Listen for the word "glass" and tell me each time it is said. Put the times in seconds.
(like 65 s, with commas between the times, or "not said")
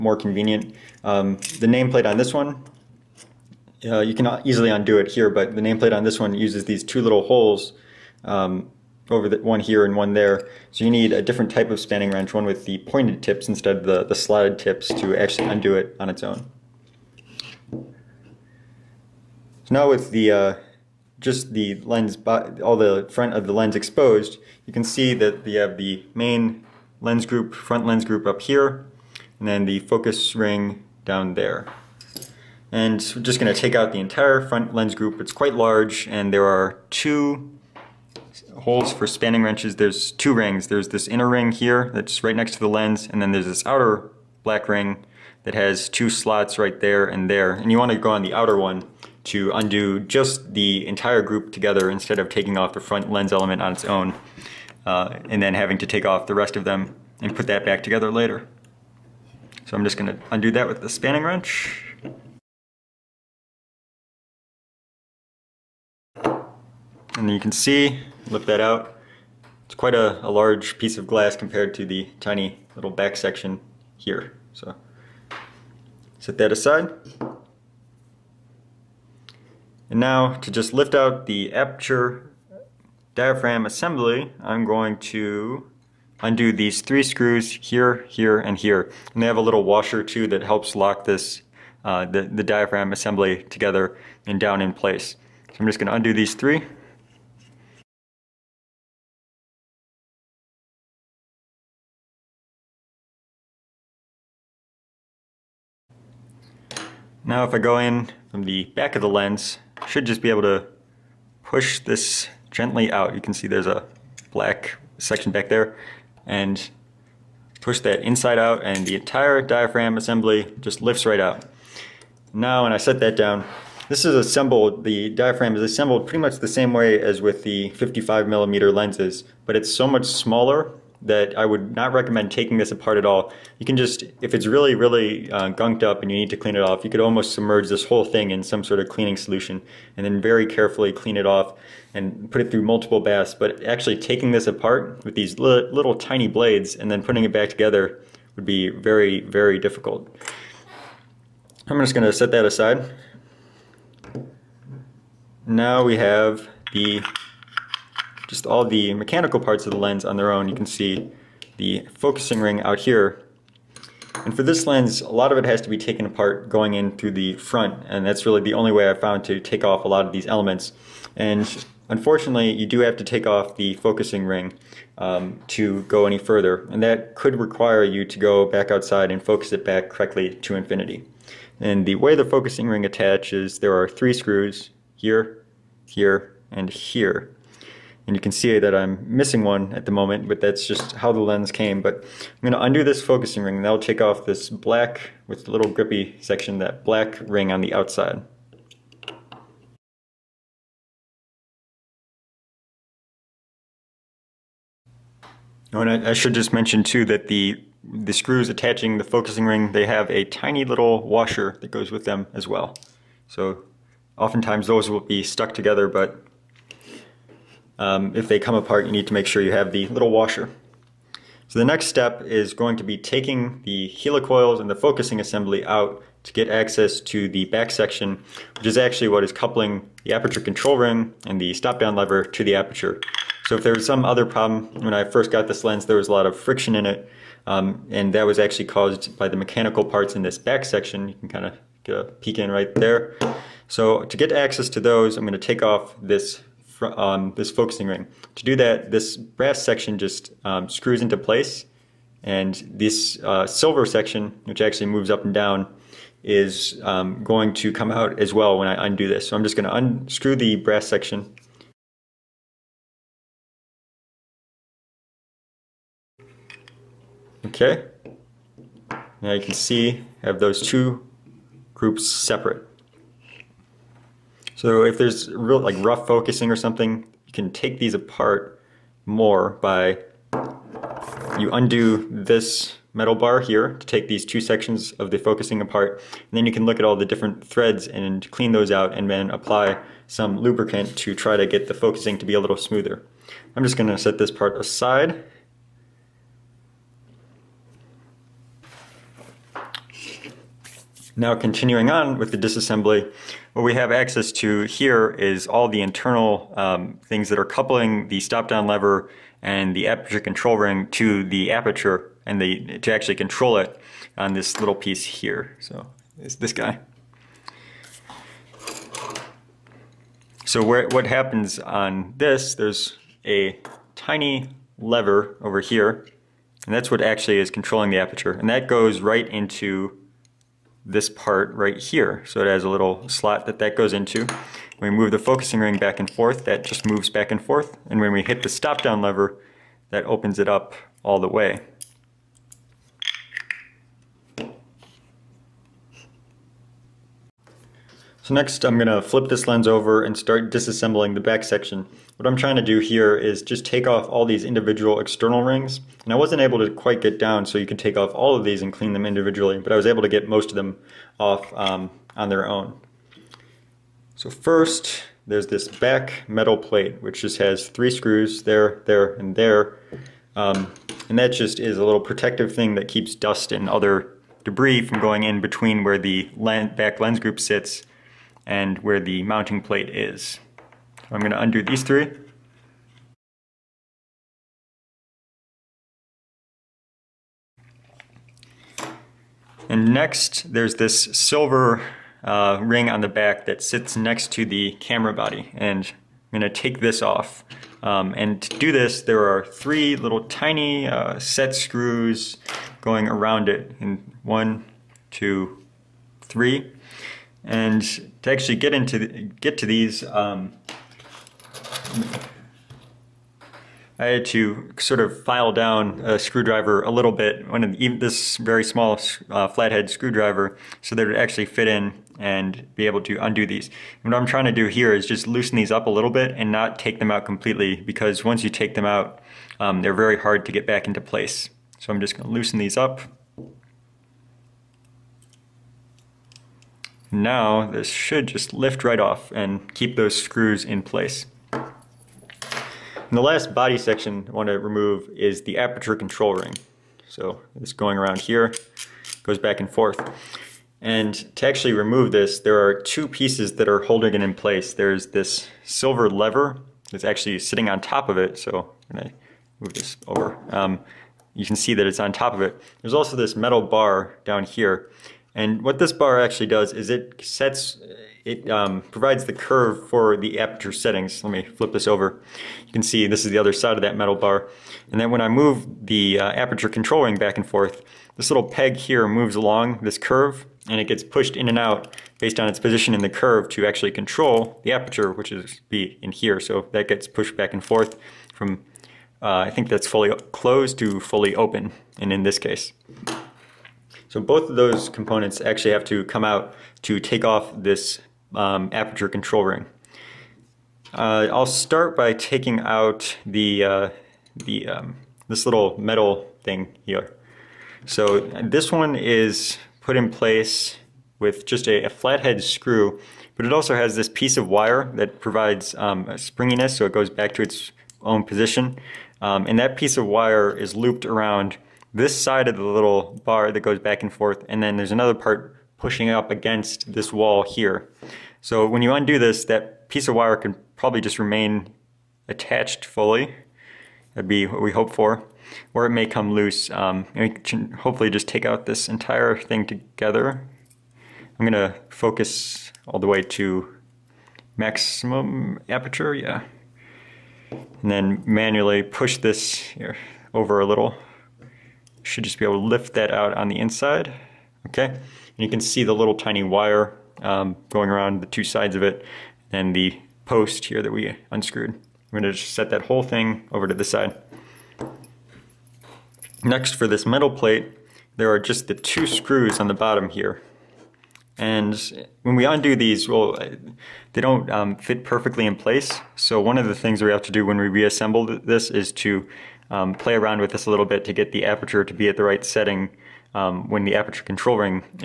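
71 s.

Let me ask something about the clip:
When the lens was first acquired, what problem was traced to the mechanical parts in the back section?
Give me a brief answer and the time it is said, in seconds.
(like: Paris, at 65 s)
friction, at 236 s.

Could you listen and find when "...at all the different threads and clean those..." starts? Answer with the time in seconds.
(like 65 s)
286 s.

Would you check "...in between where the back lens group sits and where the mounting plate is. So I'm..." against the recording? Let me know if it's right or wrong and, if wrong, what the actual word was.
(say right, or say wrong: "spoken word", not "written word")
right.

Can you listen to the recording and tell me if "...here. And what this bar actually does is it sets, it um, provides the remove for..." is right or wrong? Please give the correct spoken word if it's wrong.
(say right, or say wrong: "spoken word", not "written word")
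wrong: "curve", not "remove".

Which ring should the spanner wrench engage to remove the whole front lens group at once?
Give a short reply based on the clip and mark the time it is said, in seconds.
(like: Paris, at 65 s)
outer black ring, at 43 s.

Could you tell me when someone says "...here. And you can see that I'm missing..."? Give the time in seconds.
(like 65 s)
186 s.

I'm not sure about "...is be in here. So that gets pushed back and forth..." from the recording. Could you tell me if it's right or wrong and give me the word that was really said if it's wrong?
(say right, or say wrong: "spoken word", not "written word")
right.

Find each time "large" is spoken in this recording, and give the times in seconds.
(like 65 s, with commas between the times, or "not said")
35 s, 70 s.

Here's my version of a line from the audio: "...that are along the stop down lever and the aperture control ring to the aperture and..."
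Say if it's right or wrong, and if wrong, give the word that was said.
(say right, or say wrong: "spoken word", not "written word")
wrong: "coupling", not "along".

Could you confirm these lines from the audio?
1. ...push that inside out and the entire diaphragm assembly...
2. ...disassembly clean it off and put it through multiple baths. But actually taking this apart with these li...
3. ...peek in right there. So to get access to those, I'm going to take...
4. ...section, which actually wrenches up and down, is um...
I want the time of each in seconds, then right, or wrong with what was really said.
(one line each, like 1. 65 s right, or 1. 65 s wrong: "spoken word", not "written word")
1. 117 s right
2. 140 s wrong: "carefully", not "disassembly"
3. 242 s right
4. 253 s wrong: "moves", not "wrenches".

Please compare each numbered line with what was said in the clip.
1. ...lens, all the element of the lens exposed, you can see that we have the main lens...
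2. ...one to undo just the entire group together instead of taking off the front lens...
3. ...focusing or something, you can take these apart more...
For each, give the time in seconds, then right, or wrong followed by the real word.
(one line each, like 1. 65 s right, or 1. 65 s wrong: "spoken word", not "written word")
1. 21 s wrong: "front", not "element"
2. 48 s right
3. 276 s right.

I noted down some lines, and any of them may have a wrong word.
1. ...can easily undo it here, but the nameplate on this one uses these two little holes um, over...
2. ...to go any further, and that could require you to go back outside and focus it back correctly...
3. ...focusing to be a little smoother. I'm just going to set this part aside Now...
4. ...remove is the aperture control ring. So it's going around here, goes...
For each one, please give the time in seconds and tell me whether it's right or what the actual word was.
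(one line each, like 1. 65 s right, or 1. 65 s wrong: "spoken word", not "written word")
1. 4 s right
2. 175 s right
3. 291 s right
4. 444 s right.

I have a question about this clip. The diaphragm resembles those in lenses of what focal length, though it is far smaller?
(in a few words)
55 millimeter.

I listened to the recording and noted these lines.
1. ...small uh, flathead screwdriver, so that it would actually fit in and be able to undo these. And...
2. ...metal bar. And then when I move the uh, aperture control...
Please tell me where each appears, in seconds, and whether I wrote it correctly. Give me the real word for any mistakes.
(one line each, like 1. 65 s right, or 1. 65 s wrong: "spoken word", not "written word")
1. 418 s right
2. 473 s right.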